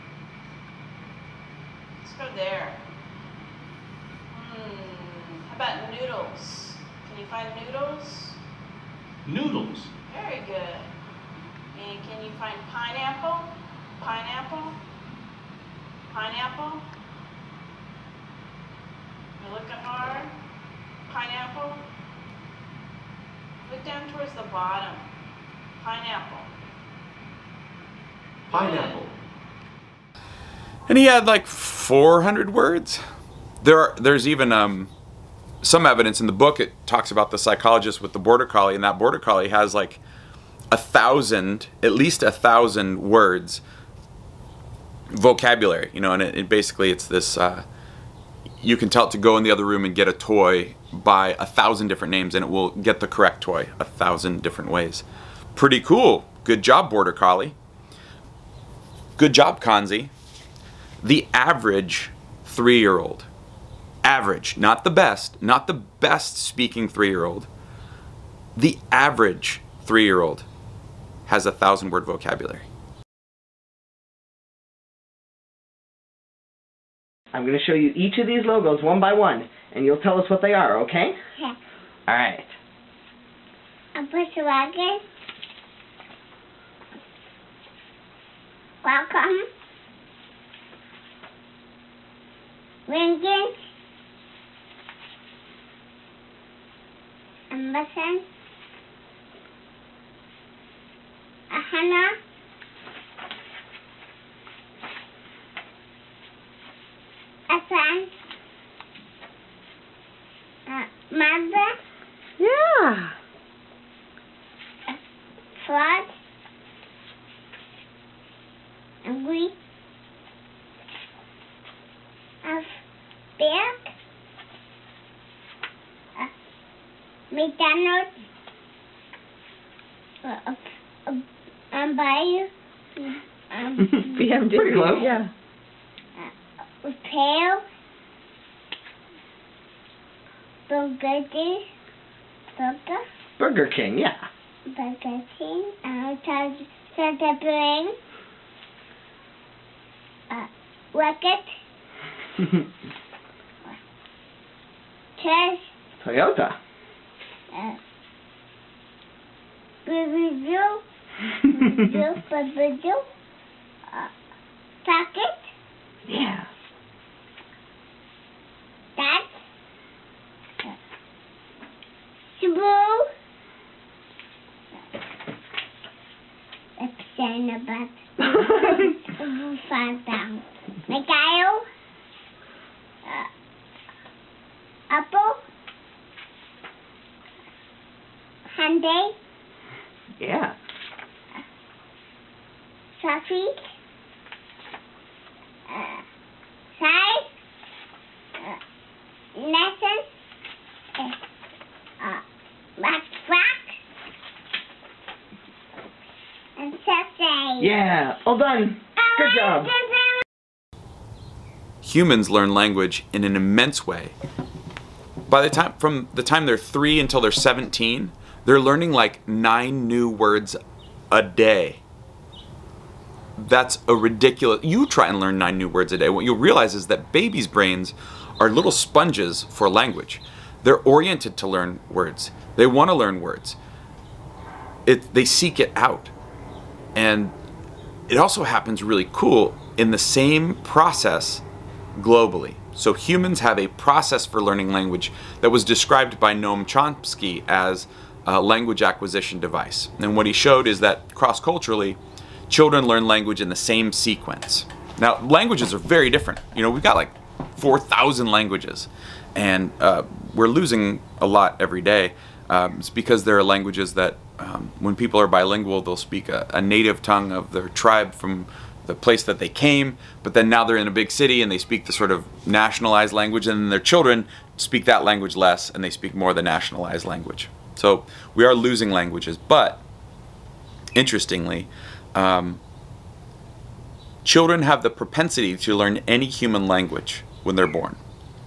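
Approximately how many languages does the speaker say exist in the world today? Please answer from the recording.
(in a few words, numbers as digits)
4,000.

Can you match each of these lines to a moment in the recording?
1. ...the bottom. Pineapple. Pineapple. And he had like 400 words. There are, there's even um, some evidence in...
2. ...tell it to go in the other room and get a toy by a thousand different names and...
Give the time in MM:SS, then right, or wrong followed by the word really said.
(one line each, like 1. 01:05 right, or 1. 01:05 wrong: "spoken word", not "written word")
1. 00:24 right
2. 00:48 right.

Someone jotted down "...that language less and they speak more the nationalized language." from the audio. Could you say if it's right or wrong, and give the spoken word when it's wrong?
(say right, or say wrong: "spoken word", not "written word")
right.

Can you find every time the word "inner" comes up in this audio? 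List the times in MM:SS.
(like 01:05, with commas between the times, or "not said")
not said.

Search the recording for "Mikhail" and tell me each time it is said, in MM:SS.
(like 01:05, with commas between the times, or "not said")
03:00.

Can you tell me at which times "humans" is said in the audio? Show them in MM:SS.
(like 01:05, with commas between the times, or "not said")
03:31, 04:02, 04:46.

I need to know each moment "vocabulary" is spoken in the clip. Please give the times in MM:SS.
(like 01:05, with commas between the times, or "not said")
00:45, 01:12.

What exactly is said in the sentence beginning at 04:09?
And what he showed is that cross-culturally, children learn language in the same sequence.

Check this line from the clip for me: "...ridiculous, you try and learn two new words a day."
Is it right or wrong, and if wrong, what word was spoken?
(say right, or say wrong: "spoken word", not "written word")
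wrong: "nine", not "two".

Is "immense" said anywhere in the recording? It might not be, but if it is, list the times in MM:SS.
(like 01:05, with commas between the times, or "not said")
03:33.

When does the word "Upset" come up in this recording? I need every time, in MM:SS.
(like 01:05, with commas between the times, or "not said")
02:56.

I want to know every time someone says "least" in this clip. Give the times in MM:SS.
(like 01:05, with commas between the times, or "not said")
00:41.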